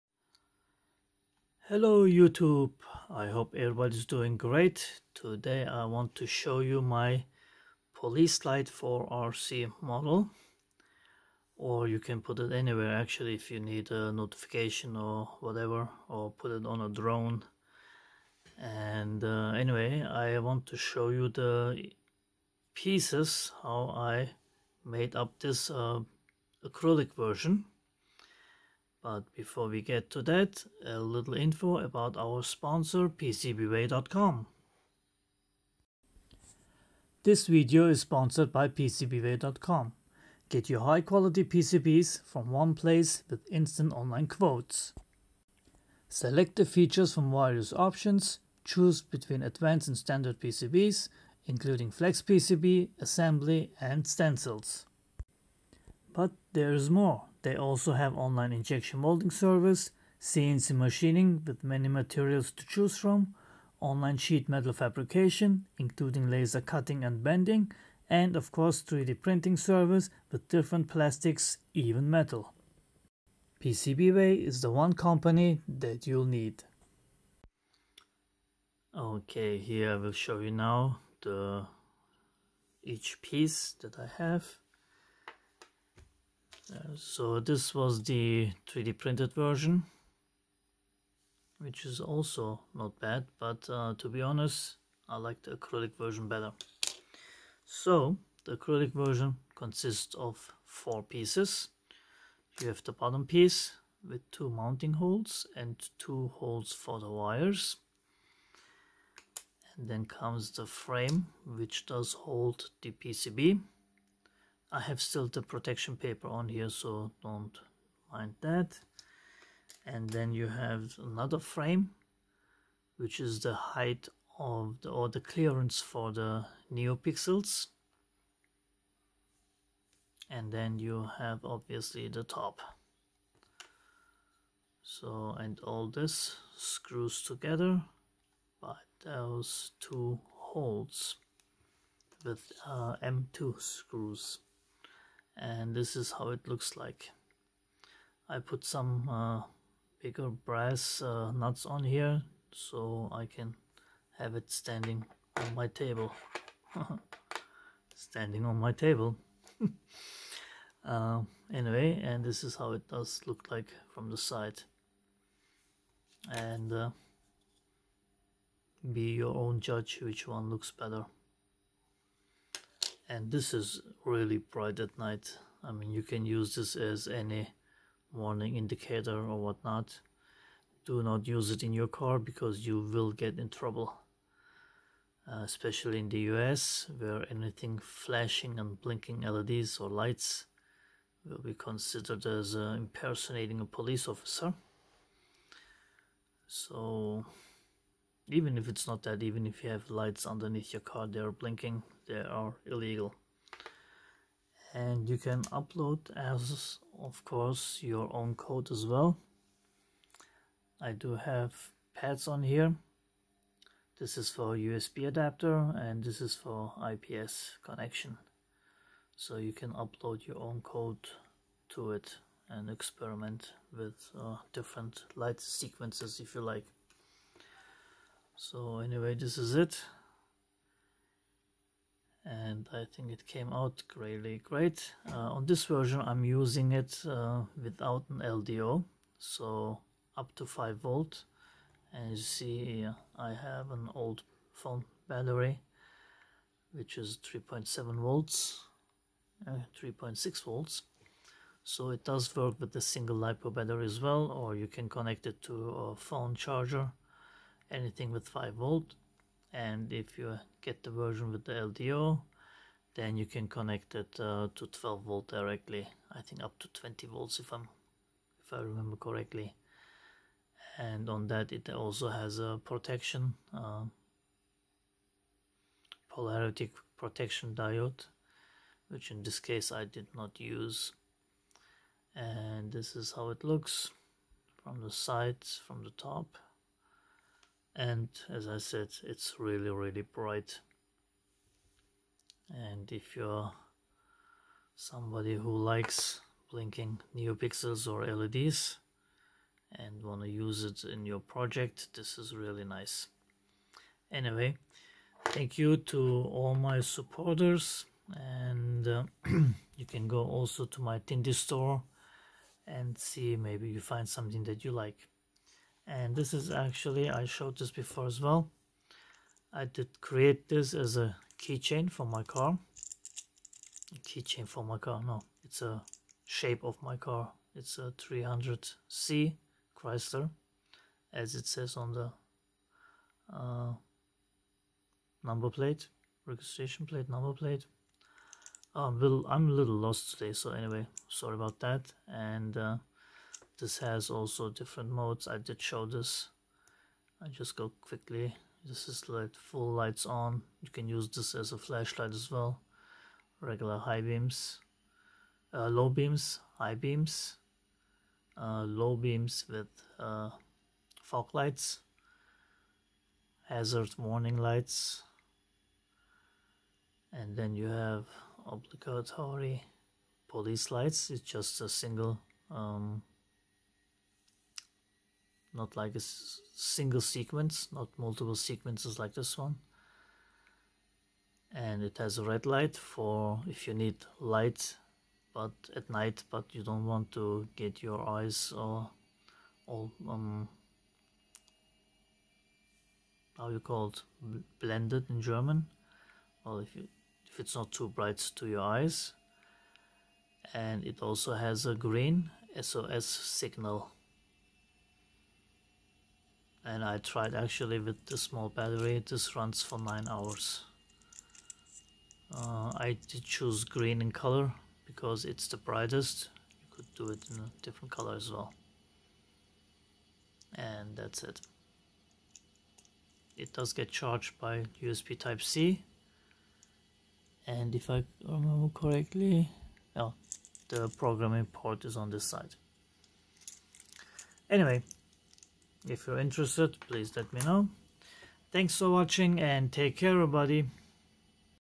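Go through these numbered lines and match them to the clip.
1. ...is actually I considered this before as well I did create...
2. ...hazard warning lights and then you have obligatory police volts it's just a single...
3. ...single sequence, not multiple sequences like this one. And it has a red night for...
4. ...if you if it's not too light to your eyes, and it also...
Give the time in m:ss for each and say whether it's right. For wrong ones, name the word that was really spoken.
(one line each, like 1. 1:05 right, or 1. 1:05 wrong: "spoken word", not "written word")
1. 5:16 wrong: "showed", not "considered"
2. 6:03 wrong: "lights", not "volts"
3. 6:16 wrong: "light", not "night"
4. 6:36 wrong: "bright", not "light".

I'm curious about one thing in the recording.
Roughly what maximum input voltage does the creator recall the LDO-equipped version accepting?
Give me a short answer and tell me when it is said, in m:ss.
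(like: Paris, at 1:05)
20 volts, at 4:26.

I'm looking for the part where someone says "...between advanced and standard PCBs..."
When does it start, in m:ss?
0:49.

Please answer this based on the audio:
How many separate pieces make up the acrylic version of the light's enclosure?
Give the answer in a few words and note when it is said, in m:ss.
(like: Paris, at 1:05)
4, at 1:40.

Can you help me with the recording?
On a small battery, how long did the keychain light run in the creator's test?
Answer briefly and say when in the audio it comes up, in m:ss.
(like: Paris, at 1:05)
9 hours, at 6:49.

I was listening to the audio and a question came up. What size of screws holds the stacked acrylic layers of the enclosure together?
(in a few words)
M2.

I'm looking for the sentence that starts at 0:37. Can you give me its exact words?
This video is sponsored by PCBWay.com.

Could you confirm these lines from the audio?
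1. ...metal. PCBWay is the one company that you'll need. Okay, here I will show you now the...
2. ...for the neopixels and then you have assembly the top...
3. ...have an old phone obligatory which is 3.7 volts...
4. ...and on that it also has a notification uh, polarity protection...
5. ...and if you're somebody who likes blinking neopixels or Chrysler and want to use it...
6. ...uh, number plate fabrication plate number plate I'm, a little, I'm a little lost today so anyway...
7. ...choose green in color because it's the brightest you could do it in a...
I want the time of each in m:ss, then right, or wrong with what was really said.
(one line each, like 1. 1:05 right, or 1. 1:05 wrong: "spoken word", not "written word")
1. 1:12 right
2. 2:05 wrong: "obviously", not "assembly"
3. 4:03 wrong: "battery", not "obligatory"
4. 4:30 wrong: "protection", not "notification"
5. 4:52 wrong: "LEDs", not "Chrysler"
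6. 5:33 wrong: "registration", not "fabrication"
7. 6:53 right.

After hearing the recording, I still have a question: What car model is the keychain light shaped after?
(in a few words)
Chrysler 300C.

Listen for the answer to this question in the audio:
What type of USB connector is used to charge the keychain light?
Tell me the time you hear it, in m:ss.
7:04.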